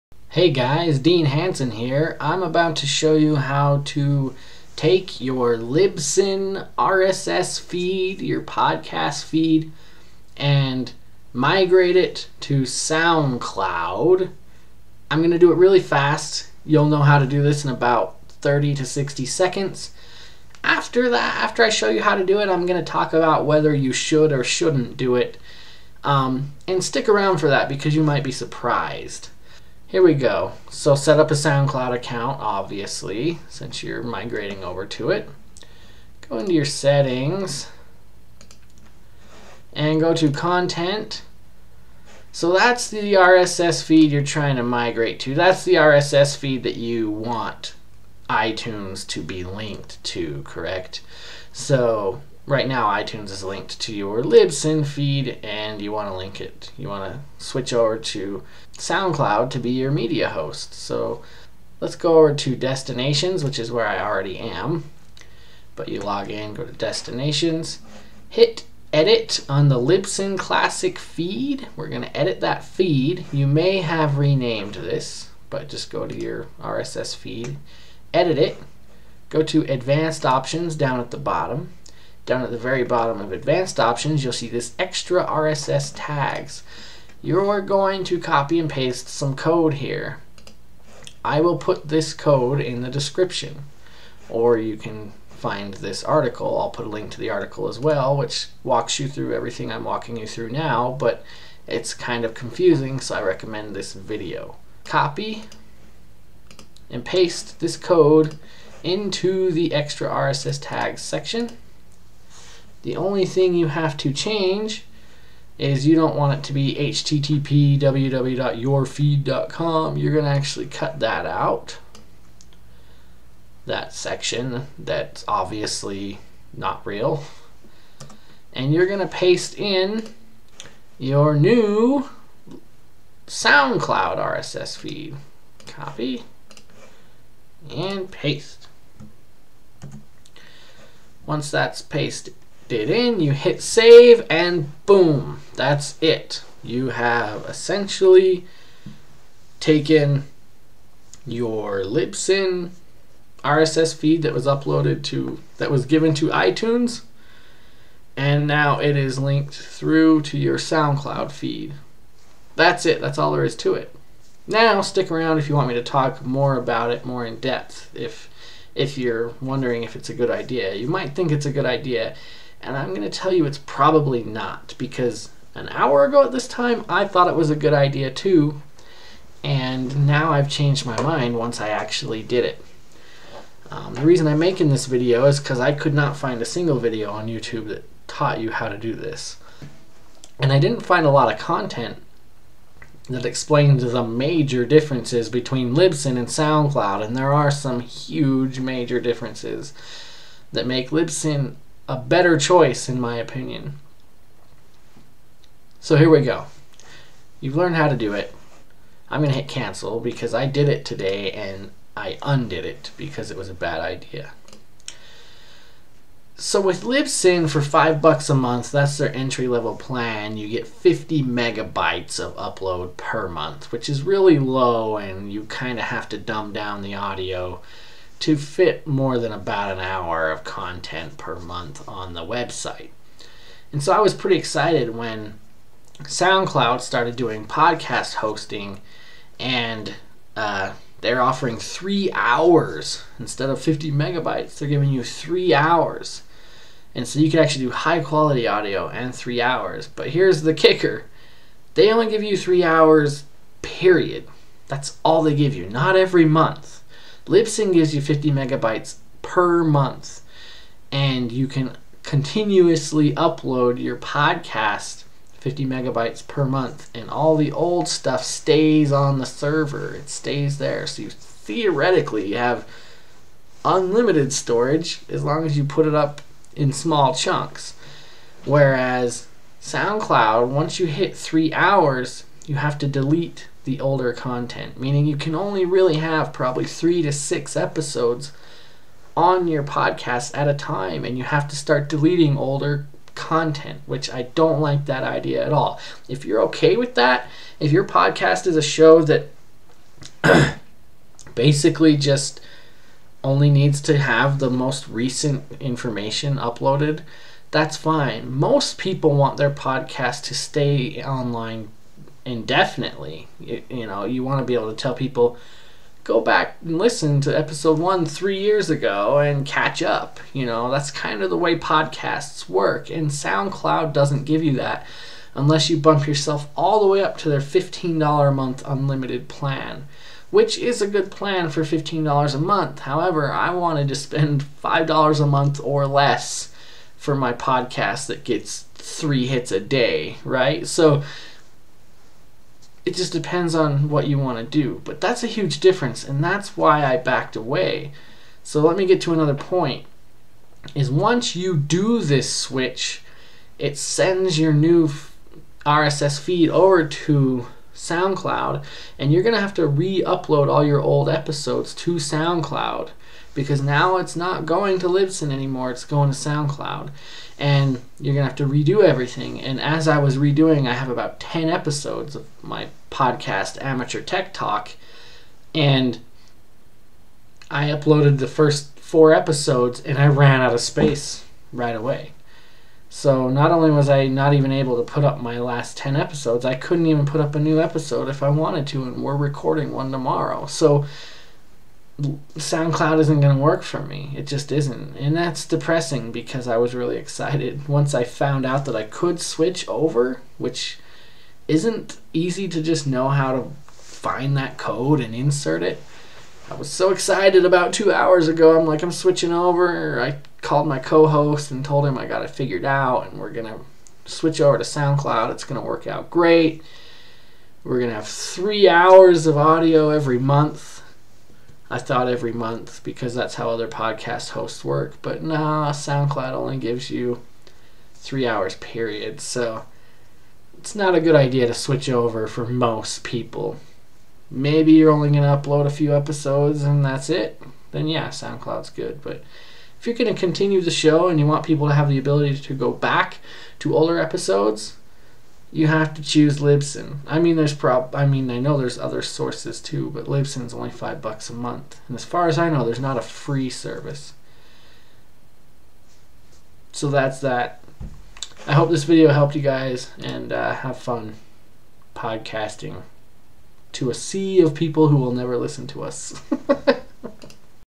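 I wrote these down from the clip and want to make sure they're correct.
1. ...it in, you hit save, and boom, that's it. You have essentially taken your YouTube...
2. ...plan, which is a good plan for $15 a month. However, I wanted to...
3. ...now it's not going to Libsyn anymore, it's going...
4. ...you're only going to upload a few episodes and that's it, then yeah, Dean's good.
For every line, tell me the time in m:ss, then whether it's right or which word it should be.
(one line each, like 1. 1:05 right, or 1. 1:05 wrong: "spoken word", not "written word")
1. 2:22 wrong: "Libsyn", not "YouTube"
2. 5:29 right
3. 6:03 right
4. 7:14 wrong: "SoundCloud", not "Dean".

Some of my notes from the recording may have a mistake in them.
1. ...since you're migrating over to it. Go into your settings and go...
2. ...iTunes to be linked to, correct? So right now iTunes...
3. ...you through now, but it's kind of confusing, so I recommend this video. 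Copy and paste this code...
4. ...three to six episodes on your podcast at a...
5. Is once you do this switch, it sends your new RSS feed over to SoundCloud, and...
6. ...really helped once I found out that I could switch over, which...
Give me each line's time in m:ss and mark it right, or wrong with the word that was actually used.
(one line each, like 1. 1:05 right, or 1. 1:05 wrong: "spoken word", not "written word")
1. 0:33 right
2. 0:48 right
3. 1:40 right
4. 4:46 right
5. 5:50 right
6. 6:36 wrong: "excited", not "helped".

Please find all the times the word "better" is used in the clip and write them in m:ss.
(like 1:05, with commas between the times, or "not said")
3:21.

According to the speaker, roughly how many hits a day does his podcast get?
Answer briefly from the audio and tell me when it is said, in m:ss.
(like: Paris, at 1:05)
3, at 5:38.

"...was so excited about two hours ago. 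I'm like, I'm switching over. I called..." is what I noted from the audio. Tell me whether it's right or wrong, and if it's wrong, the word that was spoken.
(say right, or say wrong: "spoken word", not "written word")
right.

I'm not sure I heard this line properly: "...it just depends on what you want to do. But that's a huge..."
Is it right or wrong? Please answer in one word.
right.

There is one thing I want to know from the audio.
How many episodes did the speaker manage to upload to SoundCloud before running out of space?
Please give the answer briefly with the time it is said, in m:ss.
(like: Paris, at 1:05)
4, at 6:18.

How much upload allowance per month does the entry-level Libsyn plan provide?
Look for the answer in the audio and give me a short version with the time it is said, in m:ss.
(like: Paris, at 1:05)
50 megabytes, at 3:40.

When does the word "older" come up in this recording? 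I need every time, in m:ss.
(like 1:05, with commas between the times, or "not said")
4:43, 4:52, 7:23.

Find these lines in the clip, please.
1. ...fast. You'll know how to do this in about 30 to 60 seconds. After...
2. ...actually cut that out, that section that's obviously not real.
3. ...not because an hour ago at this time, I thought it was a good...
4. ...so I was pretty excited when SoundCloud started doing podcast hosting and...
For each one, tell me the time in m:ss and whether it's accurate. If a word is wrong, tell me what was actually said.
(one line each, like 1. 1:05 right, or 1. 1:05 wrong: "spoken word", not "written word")
1. 0:15 right
2. 2:00 right
3. 2:54 right
4. 3:53 right.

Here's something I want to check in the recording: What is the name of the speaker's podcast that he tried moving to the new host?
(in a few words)
Amateur Tech Talk.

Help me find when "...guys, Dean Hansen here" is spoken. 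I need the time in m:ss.
0:00.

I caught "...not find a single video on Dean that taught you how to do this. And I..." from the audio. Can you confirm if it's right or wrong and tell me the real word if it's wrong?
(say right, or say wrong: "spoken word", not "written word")
wrong: "YouTube", not "Dean".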